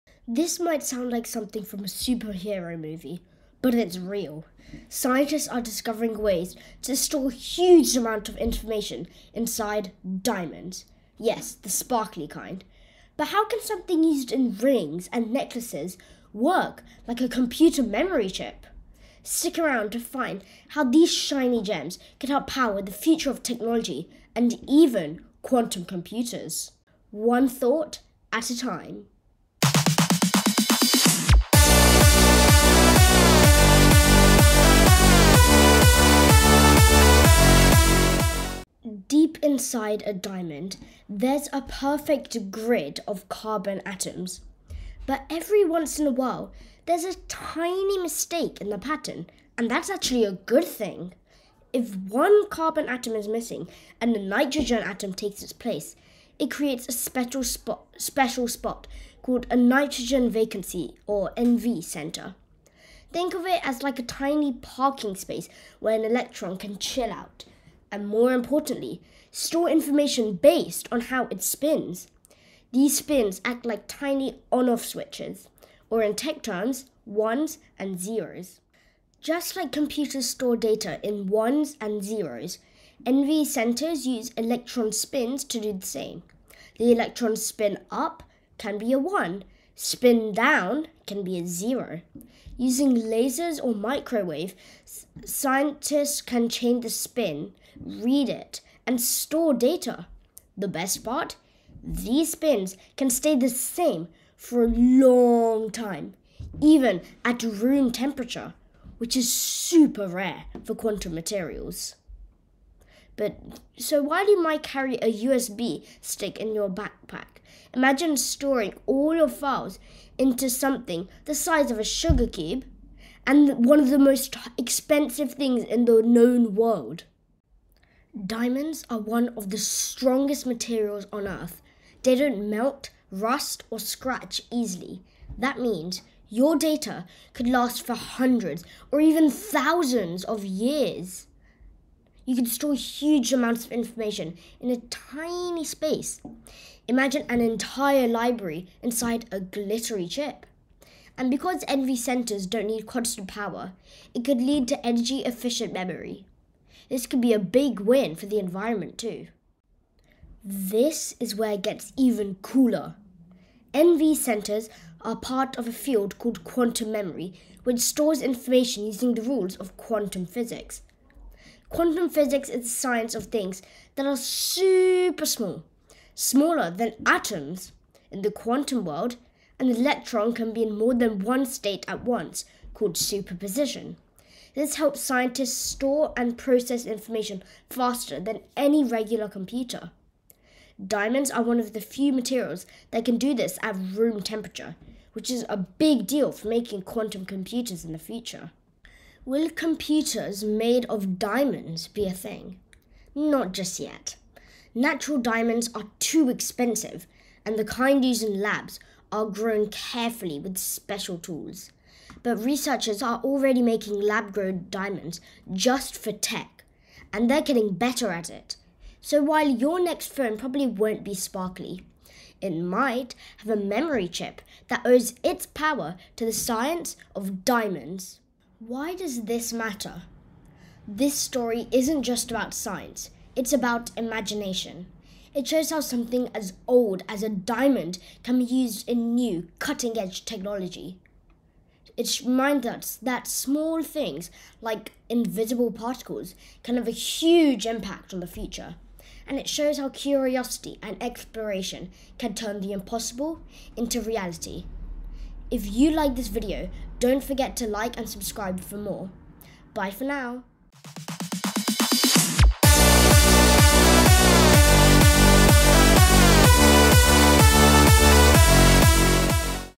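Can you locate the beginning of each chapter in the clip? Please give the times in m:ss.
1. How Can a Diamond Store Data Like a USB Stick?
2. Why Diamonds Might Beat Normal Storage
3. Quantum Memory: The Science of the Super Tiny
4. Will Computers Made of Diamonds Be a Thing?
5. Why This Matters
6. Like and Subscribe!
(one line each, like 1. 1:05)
1. 1:18
2. 2:07
3. 2:40
4. 3:19
5. 3:48
6. 4:15.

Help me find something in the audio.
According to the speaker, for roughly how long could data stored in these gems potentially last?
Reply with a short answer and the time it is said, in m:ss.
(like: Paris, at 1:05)
thousands of years, at 2:19.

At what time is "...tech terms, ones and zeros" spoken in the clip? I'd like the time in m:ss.
1:16.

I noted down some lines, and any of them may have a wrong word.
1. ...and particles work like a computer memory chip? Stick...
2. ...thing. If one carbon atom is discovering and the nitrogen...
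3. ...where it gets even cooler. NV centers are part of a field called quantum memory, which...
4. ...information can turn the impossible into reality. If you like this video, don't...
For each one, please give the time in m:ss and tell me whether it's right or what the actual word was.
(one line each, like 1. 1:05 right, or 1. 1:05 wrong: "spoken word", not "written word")
1. 0:15 wrong: "necklaces", not "particles"
2. 0:50 wrong: "missing", not "discovering"
3. 2:41 right
4. 4:10 wrong: "exploration", not "information".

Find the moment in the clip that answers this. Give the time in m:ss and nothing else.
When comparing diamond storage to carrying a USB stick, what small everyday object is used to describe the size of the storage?
2:01.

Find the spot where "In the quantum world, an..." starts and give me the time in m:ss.
2:58.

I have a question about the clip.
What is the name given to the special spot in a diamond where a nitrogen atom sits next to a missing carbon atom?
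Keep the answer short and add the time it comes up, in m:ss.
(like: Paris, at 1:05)
NV center, at 1:01.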